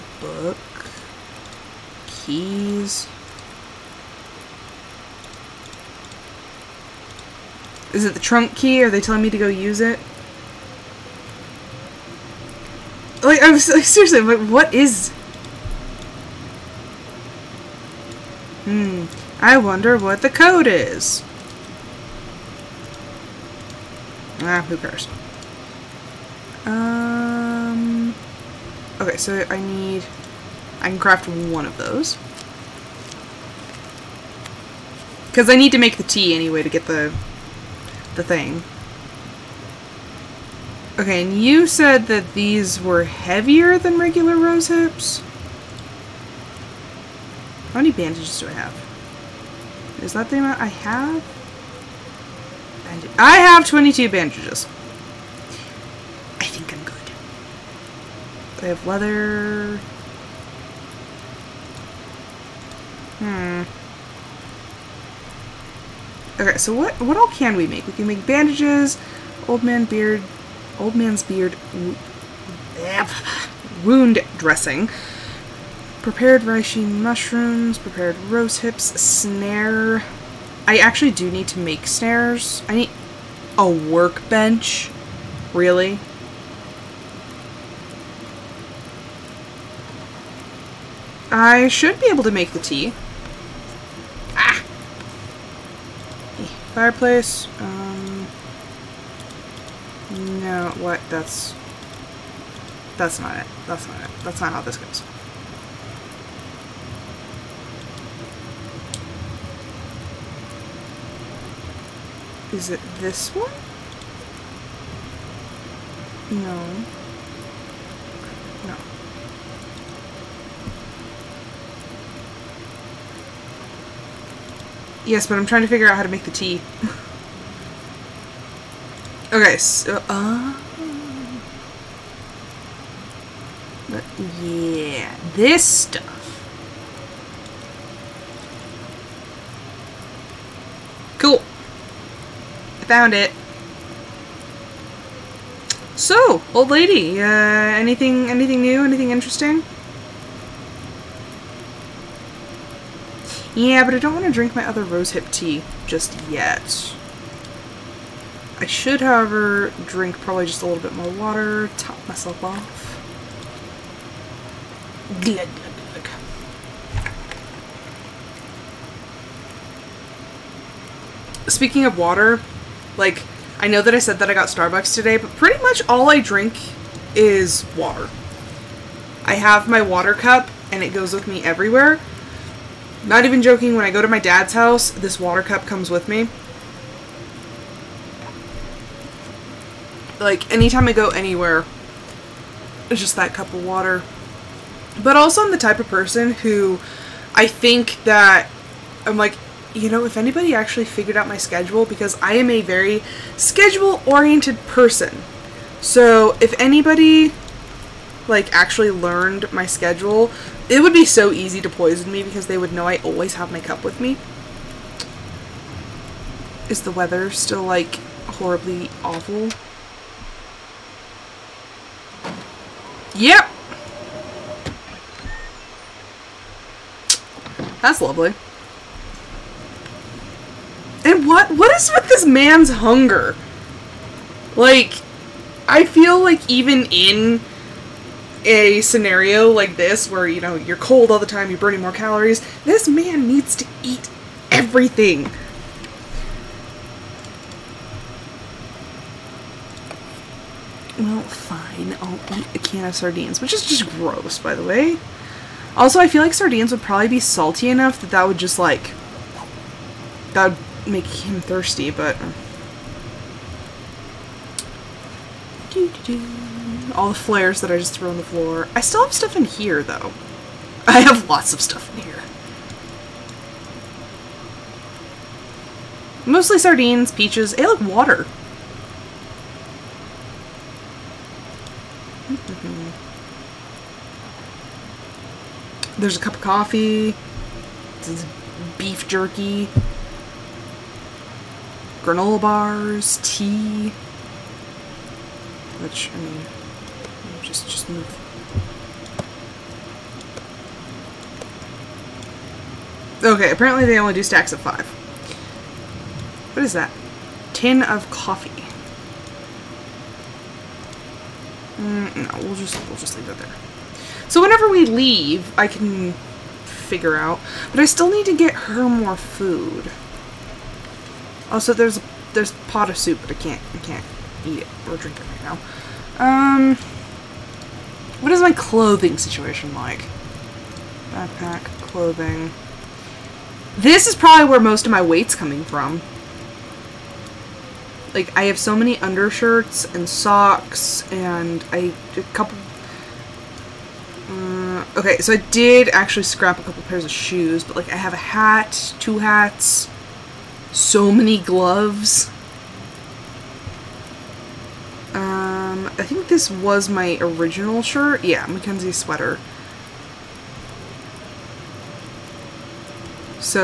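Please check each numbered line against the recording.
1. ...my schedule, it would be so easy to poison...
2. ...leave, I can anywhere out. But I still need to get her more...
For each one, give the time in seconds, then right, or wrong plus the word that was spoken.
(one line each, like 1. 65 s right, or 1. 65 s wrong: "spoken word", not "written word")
1. 209 s right
2. 314 s wrong: "figure", not "anywhere".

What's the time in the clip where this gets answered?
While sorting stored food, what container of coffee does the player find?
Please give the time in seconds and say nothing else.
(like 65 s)
307 s.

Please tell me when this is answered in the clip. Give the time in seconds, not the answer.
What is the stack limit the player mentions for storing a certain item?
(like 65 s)
304 s.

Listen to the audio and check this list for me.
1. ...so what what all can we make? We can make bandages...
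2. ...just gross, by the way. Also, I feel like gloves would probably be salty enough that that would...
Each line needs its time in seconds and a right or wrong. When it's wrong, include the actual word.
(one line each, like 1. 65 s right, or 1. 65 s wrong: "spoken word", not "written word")
1. 66 s right
2. 253 s wrong: "sardines", not "gloves".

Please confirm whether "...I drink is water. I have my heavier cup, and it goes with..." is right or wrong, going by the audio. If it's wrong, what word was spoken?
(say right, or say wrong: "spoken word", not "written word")
wrong: "water", not "heavier".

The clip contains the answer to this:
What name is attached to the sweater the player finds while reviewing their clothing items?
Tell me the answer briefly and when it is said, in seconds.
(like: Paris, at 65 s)
Mackenzie, at 358 s.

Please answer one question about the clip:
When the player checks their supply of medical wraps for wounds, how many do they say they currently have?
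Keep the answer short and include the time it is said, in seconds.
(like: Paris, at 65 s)
22, at 53 s.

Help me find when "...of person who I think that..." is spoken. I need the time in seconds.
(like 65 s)
195 s.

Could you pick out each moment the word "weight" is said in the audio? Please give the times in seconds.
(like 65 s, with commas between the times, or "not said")
335 s.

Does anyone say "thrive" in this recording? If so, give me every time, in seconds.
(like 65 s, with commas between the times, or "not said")
not said.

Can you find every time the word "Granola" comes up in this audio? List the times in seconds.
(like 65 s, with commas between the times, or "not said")
292 s.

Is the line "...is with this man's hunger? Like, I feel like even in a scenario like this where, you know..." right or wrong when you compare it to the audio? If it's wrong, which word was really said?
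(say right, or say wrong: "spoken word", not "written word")
right.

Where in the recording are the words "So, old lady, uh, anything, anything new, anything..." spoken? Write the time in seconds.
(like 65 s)
145 s.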